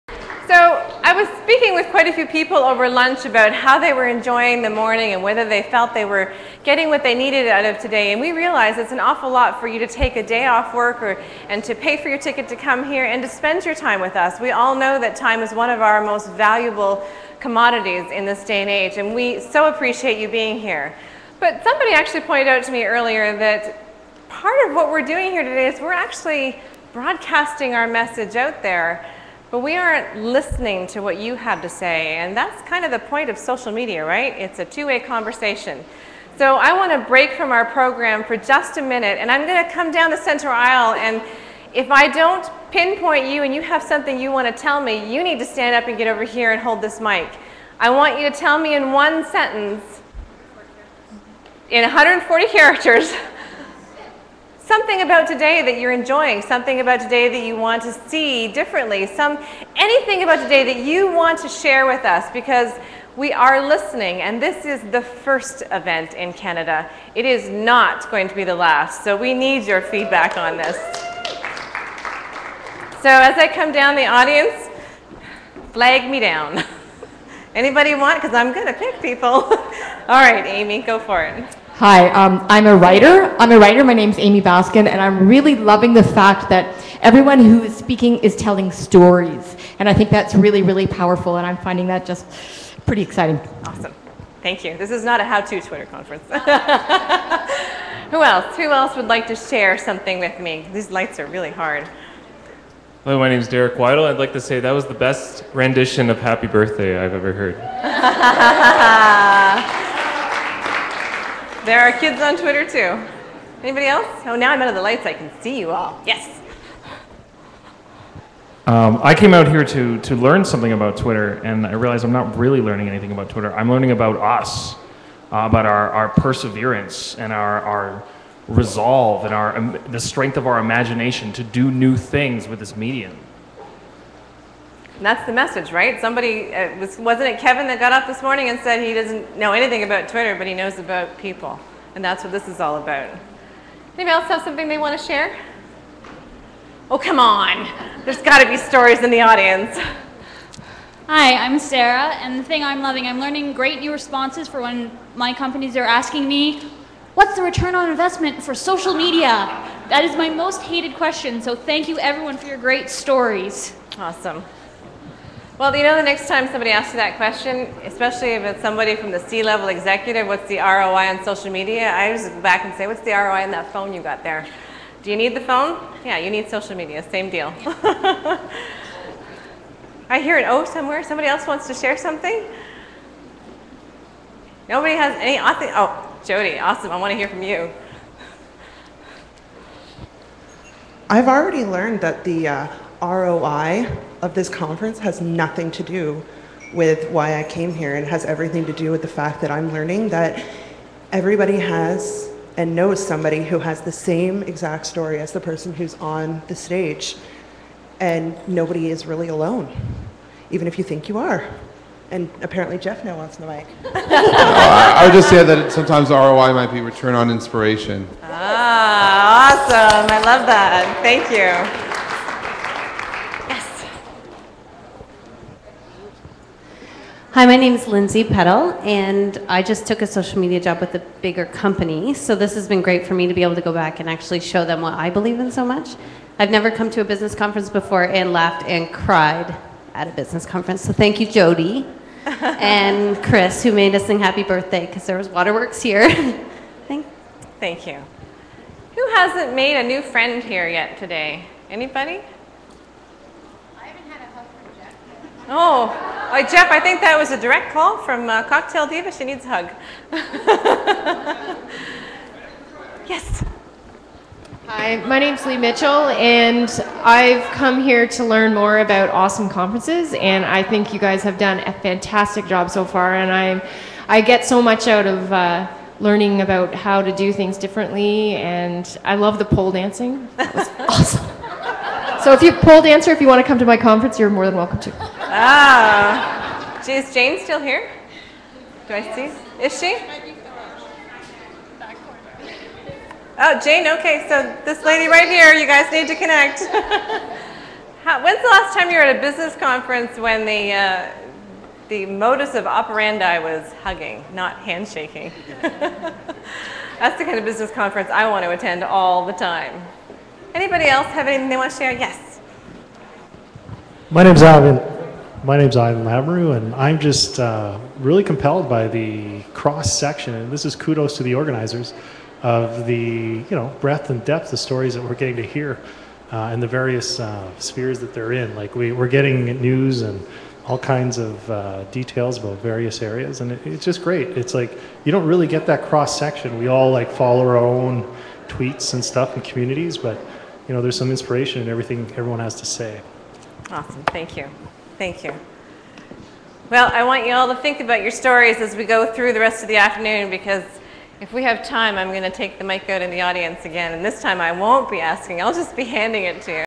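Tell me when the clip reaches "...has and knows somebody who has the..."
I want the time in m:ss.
3:21.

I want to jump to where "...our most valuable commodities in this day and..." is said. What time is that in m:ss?
0:15.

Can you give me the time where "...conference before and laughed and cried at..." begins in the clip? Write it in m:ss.
3:57.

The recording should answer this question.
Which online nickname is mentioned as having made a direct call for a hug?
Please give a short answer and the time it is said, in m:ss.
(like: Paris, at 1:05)
Cocktail Diva, at 4:18.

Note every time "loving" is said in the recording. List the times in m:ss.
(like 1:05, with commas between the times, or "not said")
1:25, 2:32.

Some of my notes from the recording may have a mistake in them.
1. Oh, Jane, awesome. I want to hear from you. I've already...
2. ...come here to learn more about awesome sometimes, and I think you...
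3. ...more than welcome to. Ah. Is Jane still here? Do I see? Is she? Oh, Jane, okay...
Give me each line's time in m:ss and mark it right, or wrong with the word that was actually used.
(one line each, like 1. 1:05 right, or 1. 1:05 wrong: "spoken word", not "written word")
1. 3:05 wrong: "Jody", not "Jane"
2. 4:27 wrong: "conferences", not "sometimes"
3. 4:44 right.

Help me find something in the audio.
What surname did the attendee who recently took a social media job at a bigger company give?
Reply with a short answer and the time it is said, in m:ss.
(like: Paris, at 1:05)
Peddle, at 3:47.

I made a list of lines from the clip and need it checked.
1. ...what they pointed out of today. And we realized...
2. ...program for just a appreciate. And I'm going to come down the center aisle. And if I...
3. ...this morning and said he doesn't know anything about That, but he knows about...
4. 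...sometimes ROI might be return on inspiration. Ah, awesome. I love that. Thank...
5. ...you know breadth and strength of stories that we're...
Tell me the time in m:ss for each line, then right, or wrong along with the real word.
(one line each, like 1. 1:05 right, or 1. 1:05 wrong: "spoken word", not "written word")
1. 0:06 wrong: "needed", not "pointed"
2. 0:37 wrong: "minute", not "appreciate"
3. 2:18 wrong: "Twitter", not "That"
4. 3:35 right
5. 5:23 wrong: "depth", not "strength".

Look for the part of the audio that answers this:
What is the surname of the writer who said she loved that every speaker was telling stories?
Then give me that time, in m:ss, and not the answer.
1:24.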